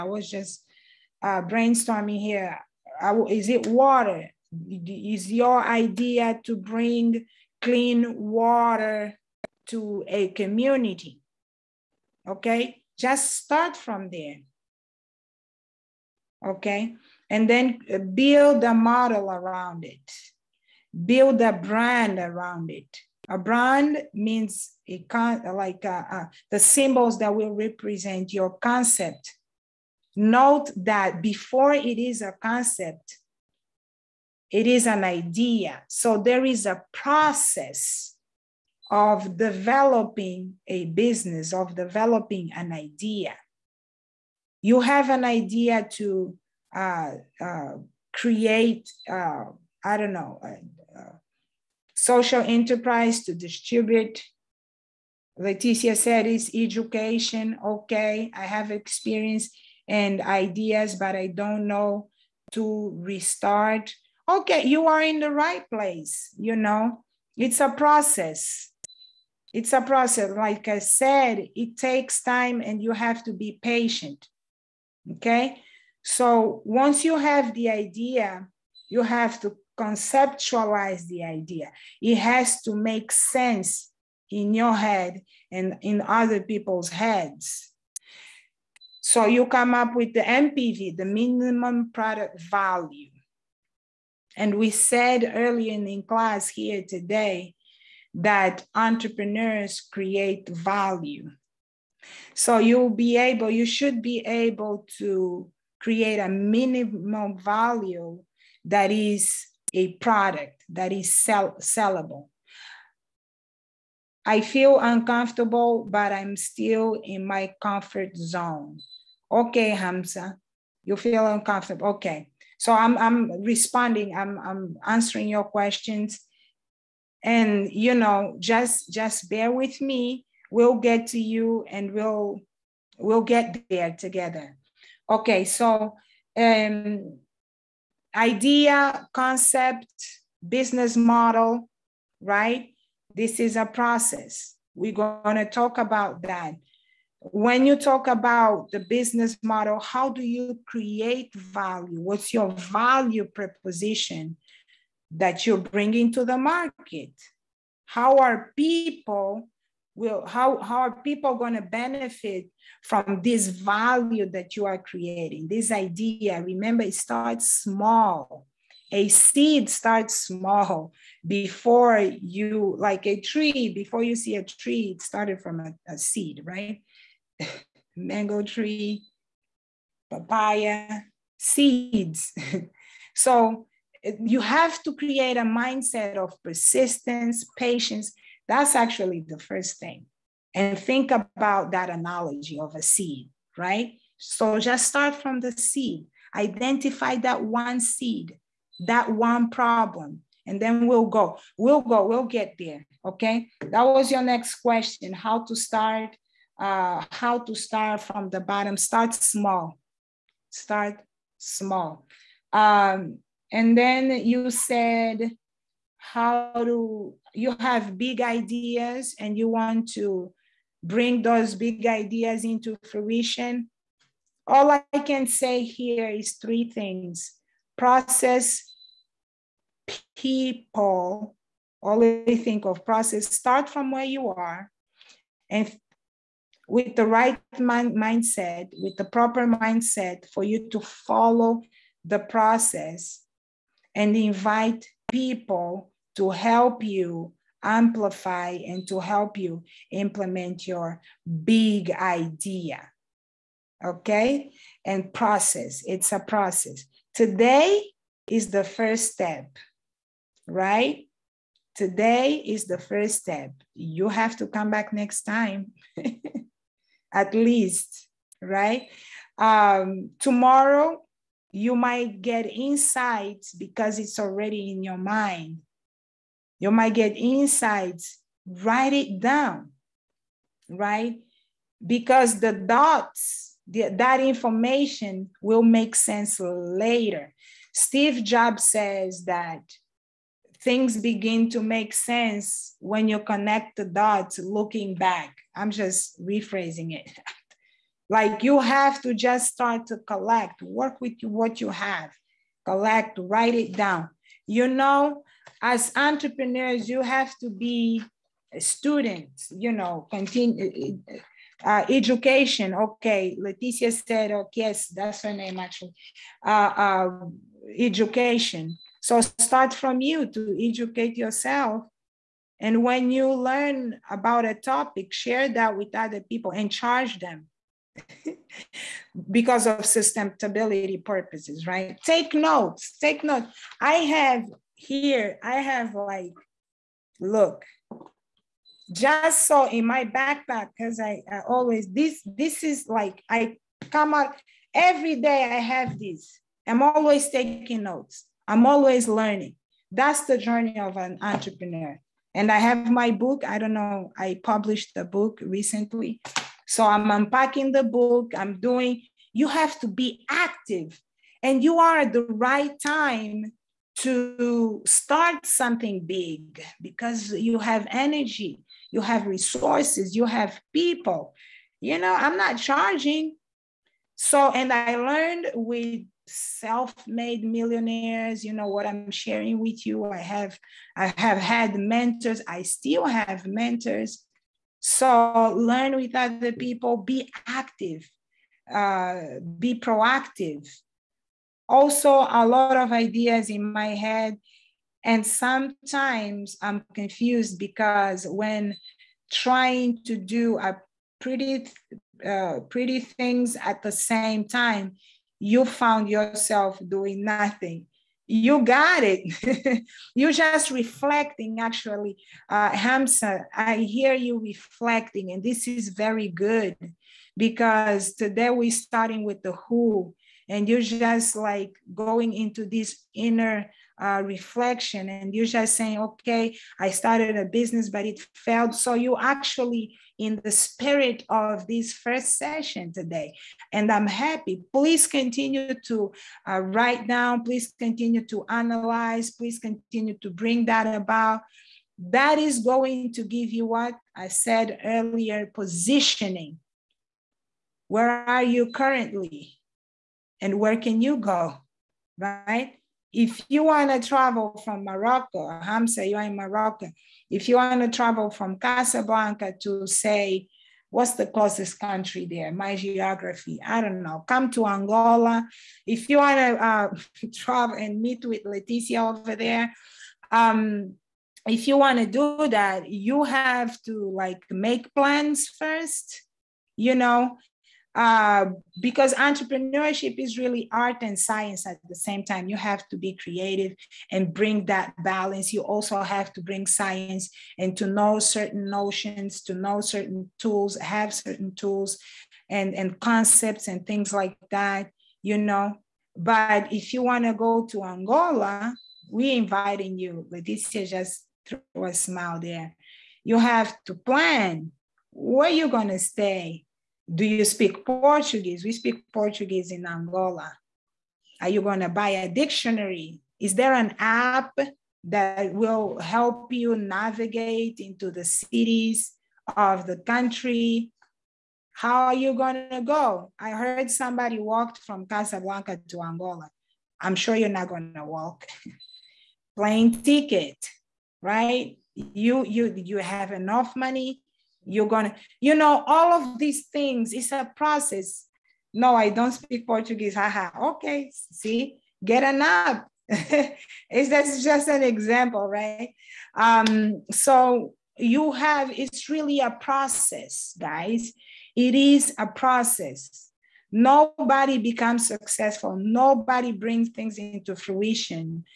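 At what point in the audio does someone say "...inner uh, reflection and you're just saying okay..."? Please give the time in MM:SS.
07:03.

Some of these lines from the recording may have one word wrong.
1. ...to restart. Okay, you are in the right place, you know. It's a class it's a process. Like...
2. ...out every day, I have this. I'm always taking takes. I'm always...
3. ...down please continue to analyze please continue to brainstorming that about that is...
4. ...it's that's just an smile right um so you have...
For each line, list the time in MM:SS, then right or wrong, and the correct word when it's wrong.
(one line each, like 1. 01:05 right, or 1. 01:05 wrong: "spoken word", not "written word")
1. 01:02 wrong: "process", not "class"
2. 05:44 wrong: "notes", not "takes"
3. 07:17 wrong: "bring", not "brainstorming"
4. 09:03 wrong: "example", not "smile".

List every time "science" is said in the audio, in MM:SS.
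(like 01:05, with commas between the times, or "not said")
08:01, 08:06.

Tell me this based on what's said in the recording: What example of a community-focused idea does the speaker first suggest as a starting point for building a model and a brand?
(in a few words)
clean water.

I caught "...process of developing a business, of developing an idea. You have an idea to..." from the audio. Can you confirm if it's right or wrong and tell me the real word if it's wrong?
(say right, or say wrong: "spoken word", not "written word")
right.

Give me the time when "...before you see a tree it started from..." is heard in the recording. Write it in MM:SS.
02:53.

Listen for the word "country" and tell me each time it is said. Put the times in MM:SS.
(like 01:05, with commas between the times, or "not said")
07:41, 08:39.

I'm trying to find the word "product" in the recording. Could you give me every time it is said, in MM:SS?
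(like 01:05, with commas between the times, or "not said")
01:31, 01:49.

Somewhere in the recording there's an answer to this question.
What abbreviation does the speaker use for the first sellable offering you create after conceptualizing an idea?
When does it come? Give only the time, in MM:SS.
01:30.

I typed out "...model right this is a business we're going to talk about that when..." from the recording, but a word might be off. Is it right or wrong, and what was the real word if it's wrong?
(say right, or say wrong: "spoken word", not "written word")
wrong: "process", not "business".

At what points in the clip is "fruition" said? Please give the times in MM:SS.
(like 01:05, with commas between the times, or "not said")
03:42, 09:17.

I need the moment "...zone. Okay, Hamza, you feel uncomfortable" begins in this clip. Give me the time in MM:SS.
01:58.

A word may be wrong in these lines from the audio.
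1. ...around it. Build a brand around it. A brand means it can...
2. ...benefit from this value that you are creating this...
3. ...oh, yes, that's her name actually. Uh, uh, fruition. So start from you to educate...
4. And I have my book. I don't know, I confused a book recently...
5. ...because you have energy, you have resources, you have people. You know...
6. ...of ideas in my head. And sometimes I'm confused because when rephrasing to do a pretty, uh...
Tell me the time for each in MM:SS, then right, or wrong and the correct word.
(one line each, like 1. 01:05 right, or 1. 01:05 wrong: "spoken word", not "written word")
1. 00:19 right
2. 02:41 right
3. 05:14 wrong: "education", not "fruition"
4. 05:52 wrong: "published", not "confused"
5. 06:06 right
6. 06:32 wrong: "trying", not "rephrasing".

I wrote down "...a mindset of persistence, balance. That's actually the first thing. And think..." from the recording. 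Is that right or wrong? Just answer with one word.
wrong.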